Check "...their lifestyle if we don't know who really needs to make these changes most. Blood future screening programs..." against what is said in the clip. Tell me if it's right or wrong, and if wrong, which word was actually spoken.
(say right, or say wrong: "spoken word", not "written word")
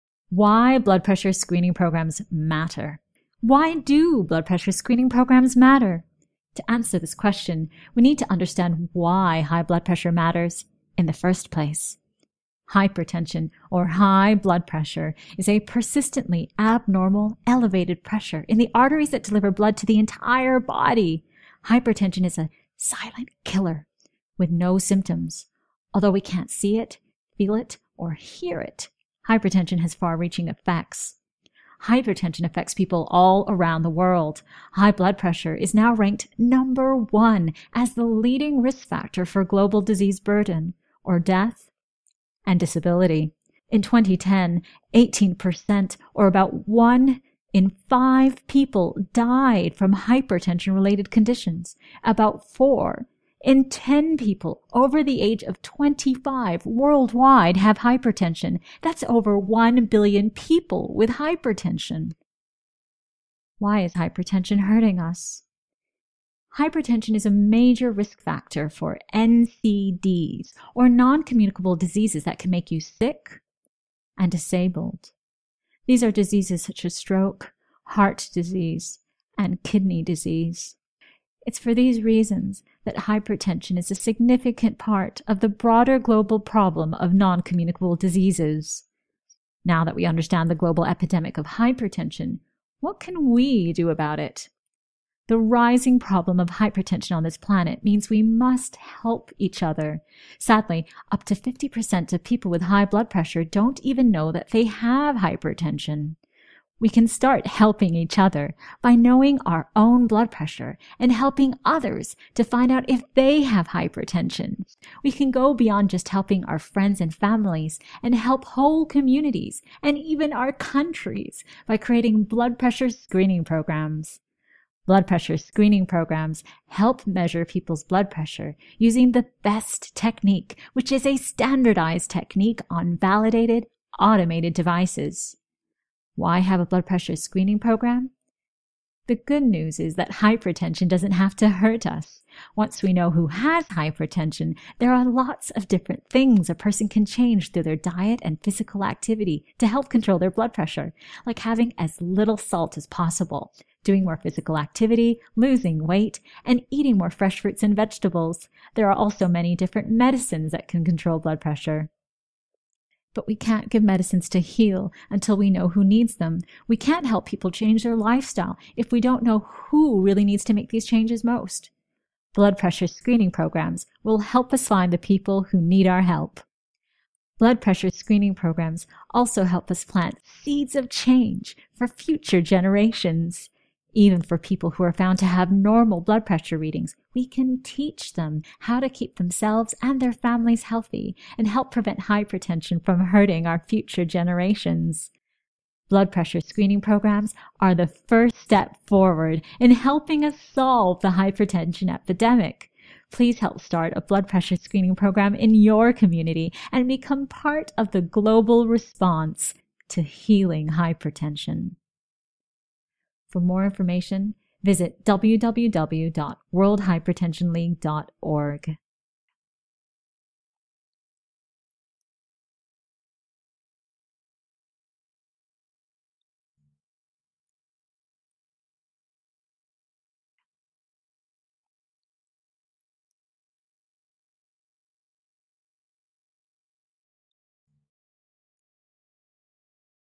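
wrong: "pressure", not "future".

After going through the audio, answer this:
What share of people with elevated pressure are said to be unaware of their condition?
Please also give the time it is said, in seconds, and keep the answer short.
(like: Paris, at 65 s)
up to 50%, at 101 s.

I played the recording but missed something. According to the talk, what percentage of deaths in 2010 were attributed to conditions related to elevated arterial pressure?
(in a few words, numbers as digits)
18%.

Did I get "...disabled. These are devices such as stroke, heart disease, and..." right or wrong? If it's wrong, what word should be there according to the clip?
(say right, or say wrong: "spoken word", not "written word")
wrong: "diseases", not "devices".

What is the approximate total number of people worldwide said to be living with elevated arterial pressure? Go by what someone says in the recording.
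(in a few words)
over 1 billion.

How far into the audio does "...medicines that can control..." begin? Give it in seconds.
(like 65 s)
159 s.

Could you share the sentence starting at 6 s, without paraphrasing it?
To answer this question, we need to understand why high blood pressure matters in the first place.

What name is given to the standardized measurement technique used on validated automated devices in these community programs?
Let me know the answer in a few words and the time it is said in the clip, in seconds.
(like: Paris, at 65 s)
BEST technique, at 129 s.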